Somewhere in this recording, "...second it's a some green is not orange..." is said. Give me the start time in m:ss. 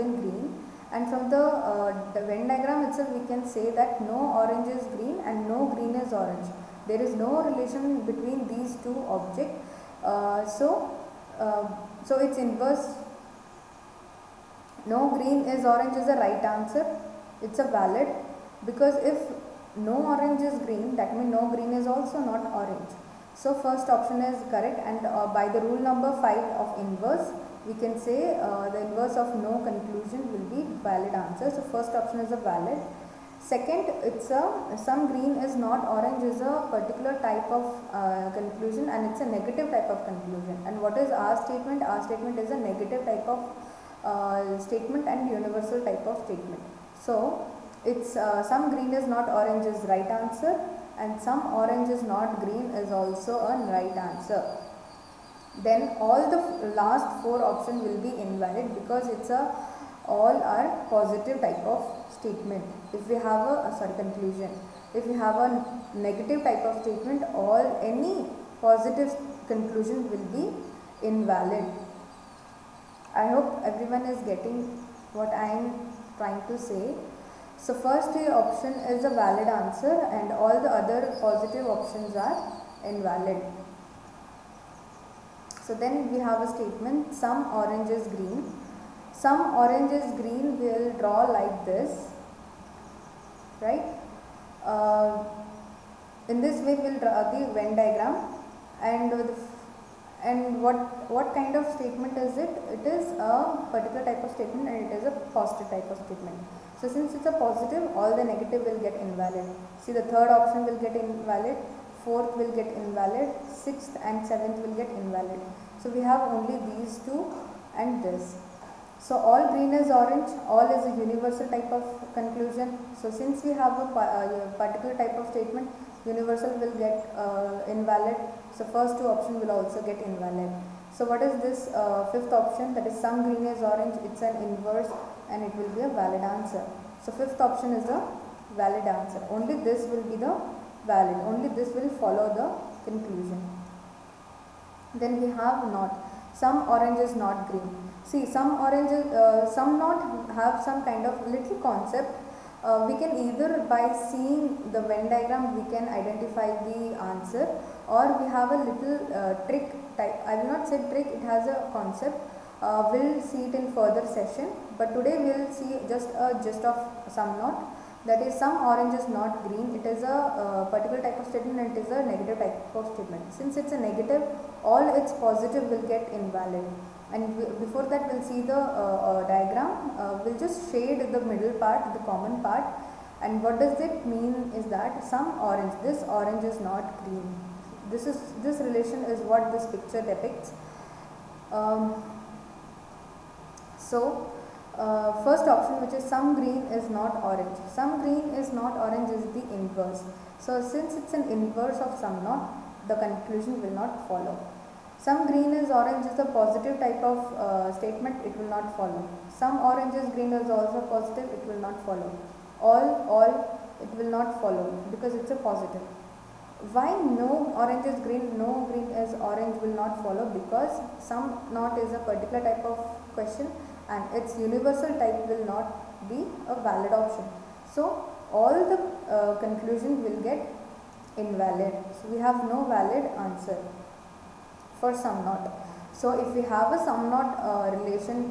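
0:33.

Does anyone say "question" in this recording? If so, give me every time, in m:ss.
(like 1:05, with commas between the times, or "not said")
3:43.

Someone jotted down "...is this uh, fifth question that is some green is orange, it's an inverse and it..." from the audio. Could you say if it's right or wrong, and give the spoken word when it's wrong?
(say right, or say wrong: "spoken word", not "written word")
wrong: "option", not "question".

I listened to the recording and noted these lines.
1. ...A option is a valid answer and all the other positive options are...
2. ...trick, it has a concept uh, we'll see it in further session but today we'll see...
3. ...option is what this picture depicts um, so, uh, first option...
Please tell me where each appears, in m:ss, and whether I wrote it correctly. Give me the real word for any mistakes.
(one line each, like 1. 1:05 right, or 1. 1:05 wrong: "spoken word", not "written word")
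1. 1:18 right
2. 2:40 right
3. 3:08 wrong: "relation", not "option".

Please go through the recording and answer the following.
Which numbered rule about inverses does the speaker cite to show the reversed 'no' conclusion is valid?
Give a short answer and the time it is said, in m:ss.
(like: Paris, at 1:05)
Rule number 5, at 0:25.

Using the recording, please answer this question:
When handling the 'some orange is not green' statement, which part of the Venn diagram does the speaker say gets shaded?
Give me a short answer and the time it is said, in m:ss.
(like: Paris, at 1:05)
The common part, at 3:01.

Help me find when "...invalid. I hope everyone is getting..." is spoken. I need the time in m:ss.
1:11.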